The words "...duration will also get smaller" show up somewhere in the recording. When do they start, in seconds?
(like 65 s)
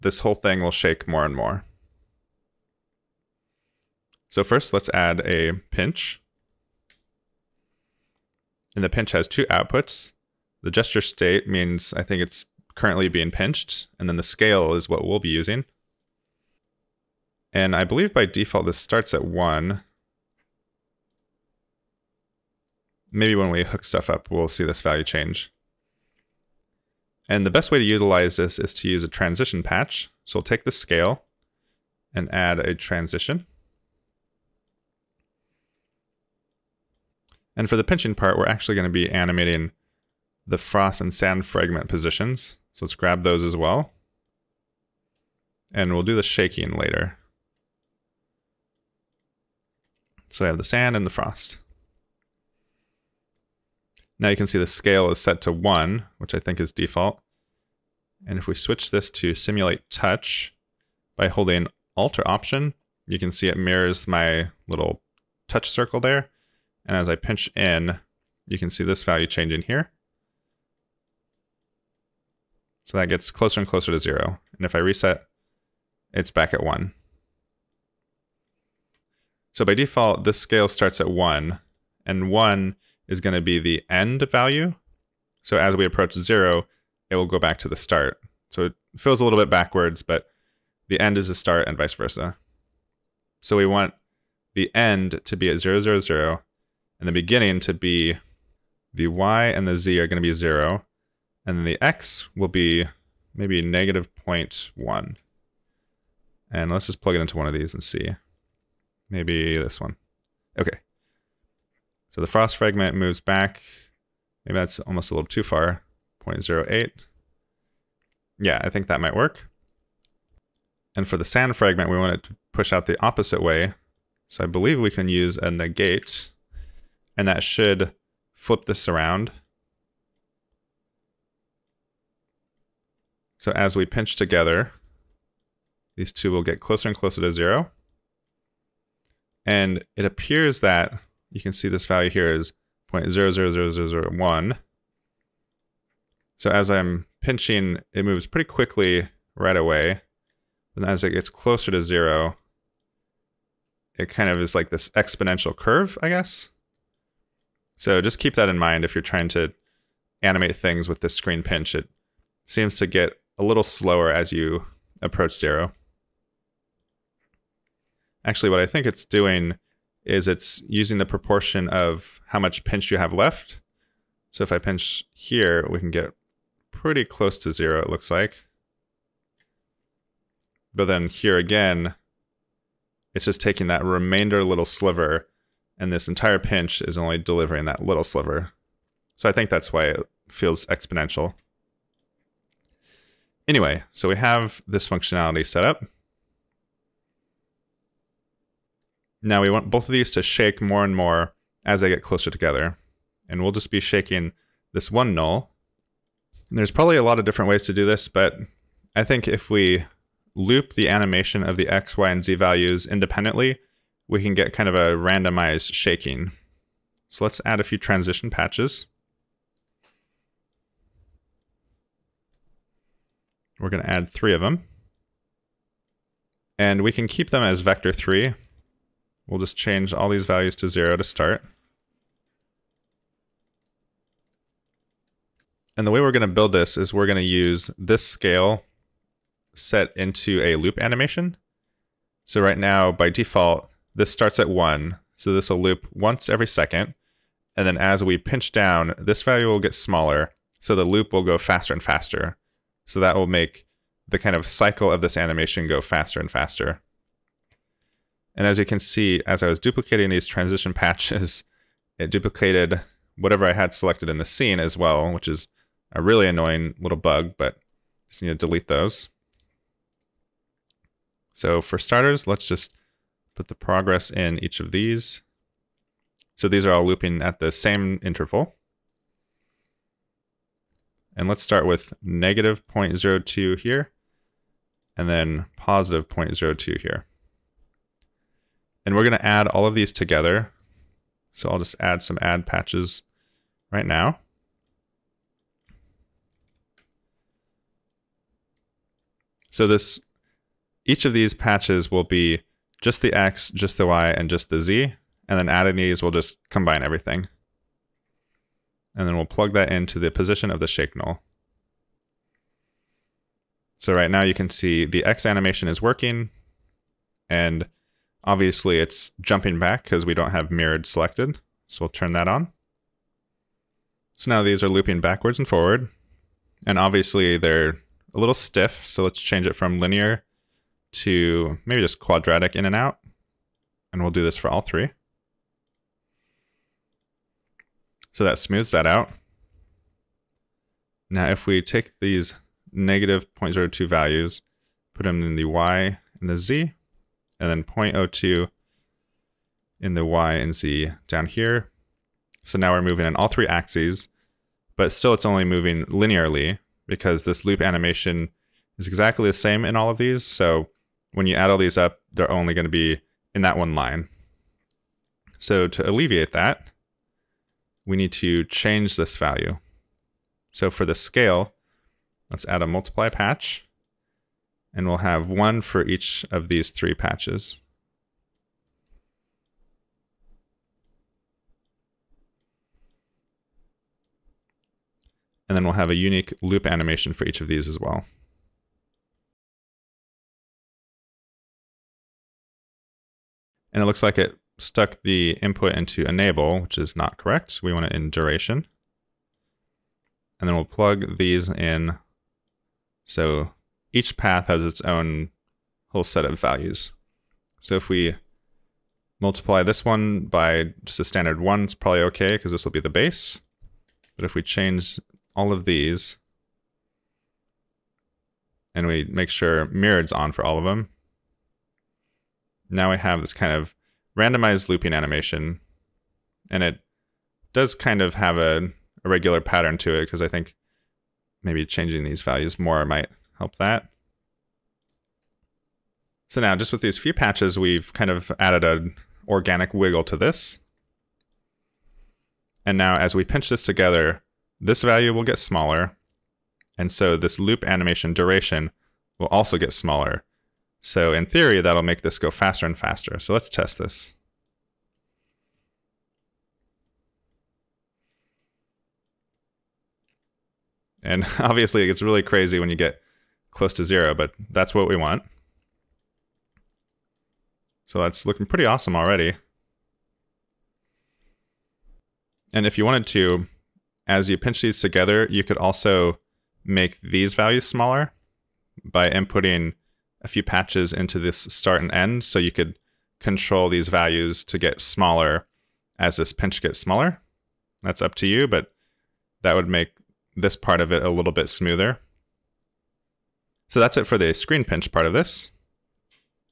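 448 s.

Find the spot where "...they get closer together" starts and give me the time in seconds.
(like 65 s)
201 s.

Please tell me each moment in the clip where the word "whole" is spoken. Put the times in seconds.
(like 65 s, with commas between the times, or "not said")
0 s, 405 s.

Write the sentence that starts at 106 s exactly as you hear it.
And let's just plug it into one of these and see.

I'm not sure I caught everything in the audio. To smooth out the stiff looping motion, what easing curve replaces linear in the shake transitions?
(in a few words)
quadratic in and out.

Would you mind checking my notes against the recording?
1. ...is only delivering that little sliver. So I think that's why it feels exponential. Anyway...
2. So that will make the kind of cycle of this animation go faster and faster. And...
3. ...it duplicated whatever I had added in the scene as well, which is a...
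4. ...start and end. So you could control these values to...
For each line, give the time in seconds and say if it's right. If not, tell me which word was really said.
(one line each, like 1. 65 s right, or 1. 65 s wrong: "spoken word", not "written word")
1. 186 s right
2. 252 s right
3. 261 s wrong: "selected", not "added"
4. 481 s right.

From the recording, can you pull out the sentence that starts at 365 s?
So to alleviate that, we need to change this value.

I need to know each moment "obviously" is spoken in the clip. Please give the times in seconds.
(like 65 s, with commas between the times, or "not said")
318 s, 326 s, 461 s.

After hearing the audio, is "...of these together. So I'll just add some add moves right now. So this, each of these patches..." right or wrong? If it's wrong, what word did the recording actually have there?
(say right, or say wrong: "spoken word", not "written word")
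wrong: "patches", not "moves".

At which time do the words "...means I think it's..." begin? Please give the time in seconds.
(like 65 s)
11 s.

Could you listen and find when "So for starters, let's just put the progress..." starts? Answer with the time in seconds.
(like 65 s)
271 s.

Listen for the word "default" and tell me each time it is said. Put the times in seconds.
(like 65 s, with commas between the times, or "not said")
18 s, 56 s, 79 s, 243 s.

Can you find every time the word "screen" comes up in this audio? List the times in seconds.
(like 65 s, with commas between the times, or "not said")
161 s, 494 s.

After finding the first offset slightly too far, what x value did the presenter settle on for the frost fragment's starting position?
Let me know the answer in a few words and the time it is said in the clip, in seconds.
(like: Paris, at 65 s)
0.08, at 116 s.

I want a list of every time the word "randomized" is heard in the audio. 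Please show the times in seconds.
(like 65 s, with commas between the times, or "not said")
214 s, 424 s.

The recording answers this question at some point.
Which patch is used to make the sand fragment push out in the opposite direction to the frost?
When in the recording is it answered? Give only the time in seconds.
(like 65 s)
125 s.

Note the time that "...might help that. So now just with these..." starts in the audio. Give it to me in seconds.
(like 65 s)
432 s.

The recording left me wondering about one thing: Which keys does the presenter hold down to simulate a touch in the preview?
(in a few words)
Alt or Option.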